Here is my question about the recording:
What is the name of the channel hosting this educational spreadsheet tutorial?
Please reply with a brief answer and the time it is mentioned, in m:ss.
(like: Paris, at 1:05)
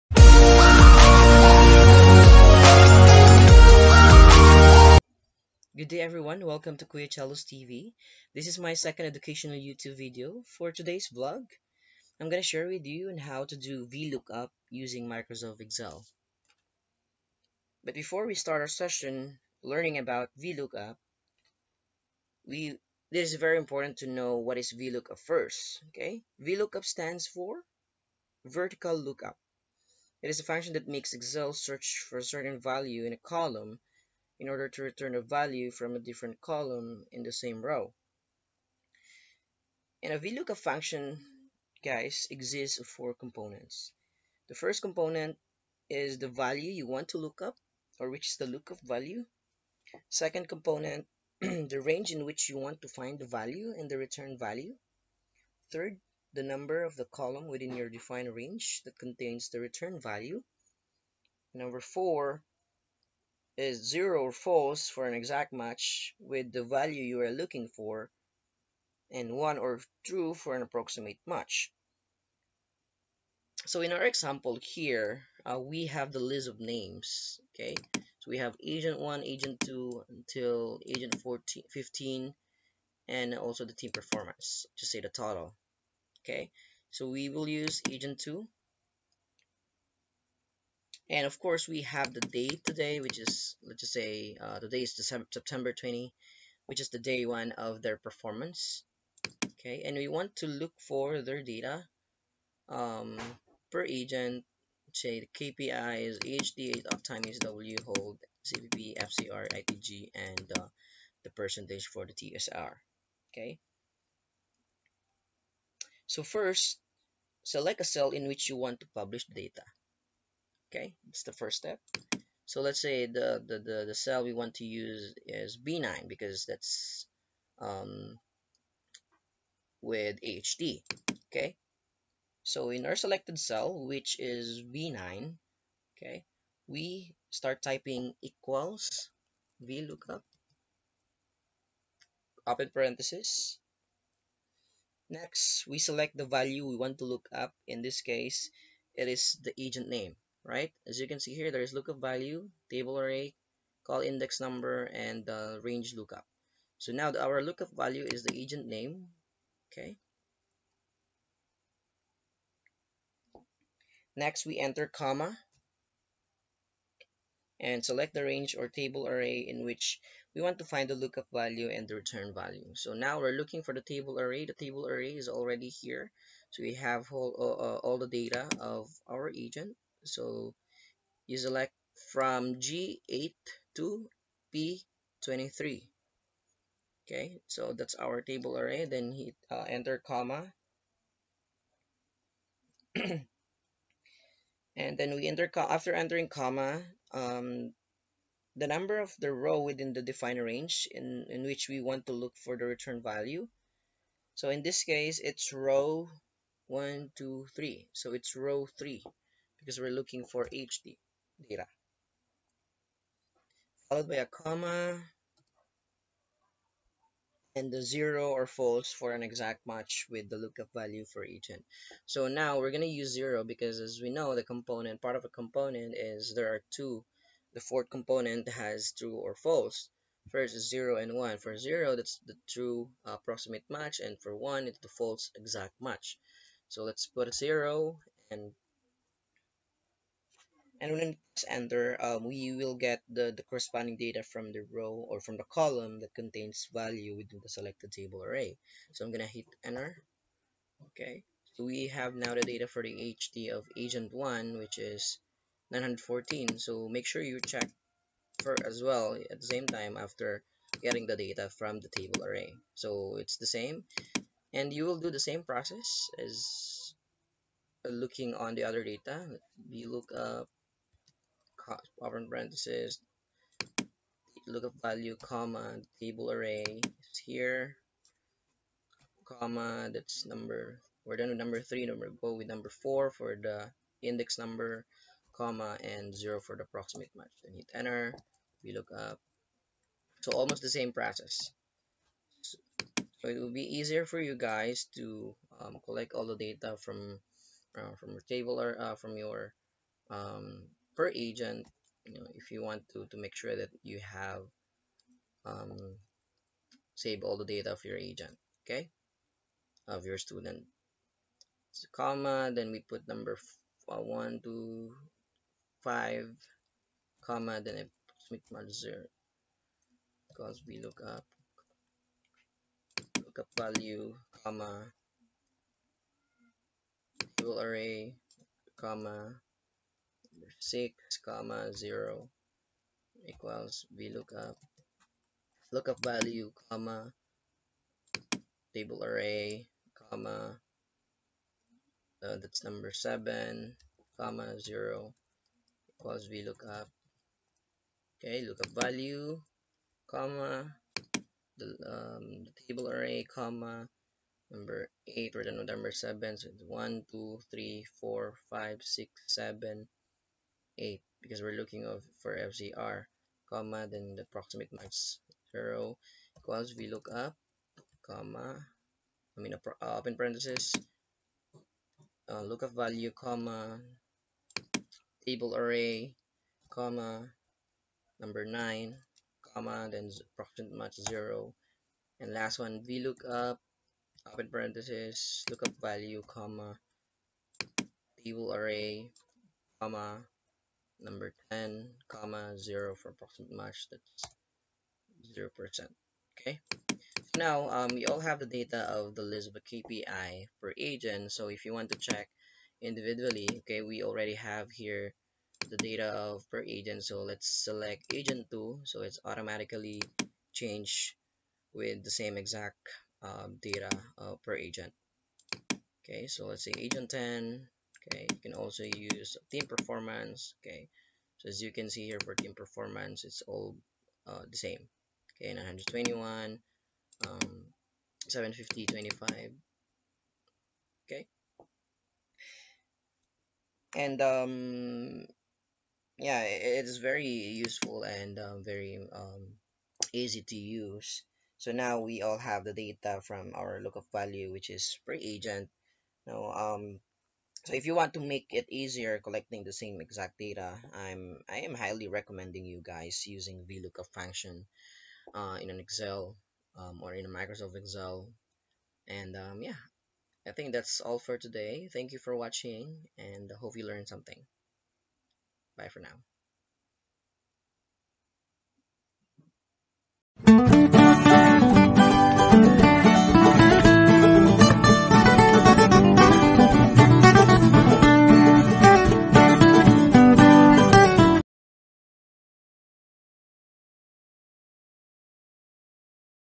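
Kuya Chello's TV, at 0:06.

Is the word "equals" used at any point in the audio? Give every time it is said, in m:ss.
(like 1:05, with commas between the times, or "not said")
2:18, 5:33, 5:45, 6:06.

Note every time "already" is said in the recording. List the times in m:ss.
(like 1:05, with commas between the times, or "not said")
2:55, 6:44.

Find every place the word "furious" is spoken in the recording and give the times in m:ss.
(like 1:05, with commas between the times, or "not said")
not said.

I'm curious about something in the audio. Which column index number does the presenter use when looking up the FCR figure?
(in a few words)
8.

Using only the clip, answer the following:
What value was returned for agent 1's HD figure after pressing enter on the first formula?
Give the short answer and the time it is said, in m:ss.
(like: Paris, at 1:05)
914, at 4:15.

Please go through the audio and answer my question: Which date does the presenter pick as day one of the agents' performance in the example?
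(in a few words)
September 20.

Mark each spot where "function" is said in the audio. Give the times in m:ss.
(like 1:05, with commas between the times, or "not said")
0:30, 0:40, 7:34.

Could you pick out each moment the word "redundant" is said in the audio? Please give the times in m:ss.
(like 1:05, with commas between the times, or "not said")
not said.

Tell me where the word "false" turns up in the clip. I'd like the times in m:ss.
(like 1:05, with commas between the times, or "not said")
1:04, 3:38, 3:49, 3:54.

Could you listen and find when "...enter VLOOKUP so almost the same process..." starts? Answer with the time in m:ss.
4:47.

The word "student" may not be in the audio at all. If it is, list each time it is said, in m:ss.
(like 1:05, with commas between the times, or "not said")
5:10.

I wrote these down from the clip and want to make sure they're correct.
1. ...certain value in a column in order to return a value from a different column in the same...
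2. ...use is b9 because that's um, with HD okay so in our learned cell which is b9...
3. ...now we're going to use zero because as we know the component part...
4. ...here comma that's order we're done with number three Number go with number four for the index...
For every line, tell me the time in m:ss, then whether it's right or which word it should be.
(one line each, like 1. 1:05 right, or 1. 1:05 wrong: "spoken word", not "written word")
1. 0:32 right
2. 2:04 wrong: "selected", not "learned"
3. 3:42 right
4. 4:37 wrong: "number", not "order".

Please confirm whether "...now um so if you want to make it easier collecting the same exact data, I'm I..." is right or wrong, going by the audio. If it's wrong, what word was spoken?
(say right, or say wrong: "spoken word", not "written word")
right.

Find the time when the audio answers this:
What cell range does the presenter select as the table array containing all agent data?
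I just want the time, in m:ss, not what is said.
3:02.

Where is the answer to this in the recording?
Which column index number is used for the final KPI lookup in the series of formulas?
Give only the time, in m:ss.
6:31.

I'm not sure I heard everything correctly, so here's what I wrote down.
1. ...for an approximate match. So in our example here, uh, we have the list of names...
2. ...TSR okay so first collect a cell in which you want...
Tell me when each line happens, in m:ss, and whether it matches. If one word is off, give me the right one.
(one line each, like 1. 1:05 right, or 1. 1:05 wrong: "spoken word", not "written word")
1. 1:10 right
2. 1:52 wrong: "select", not "collect".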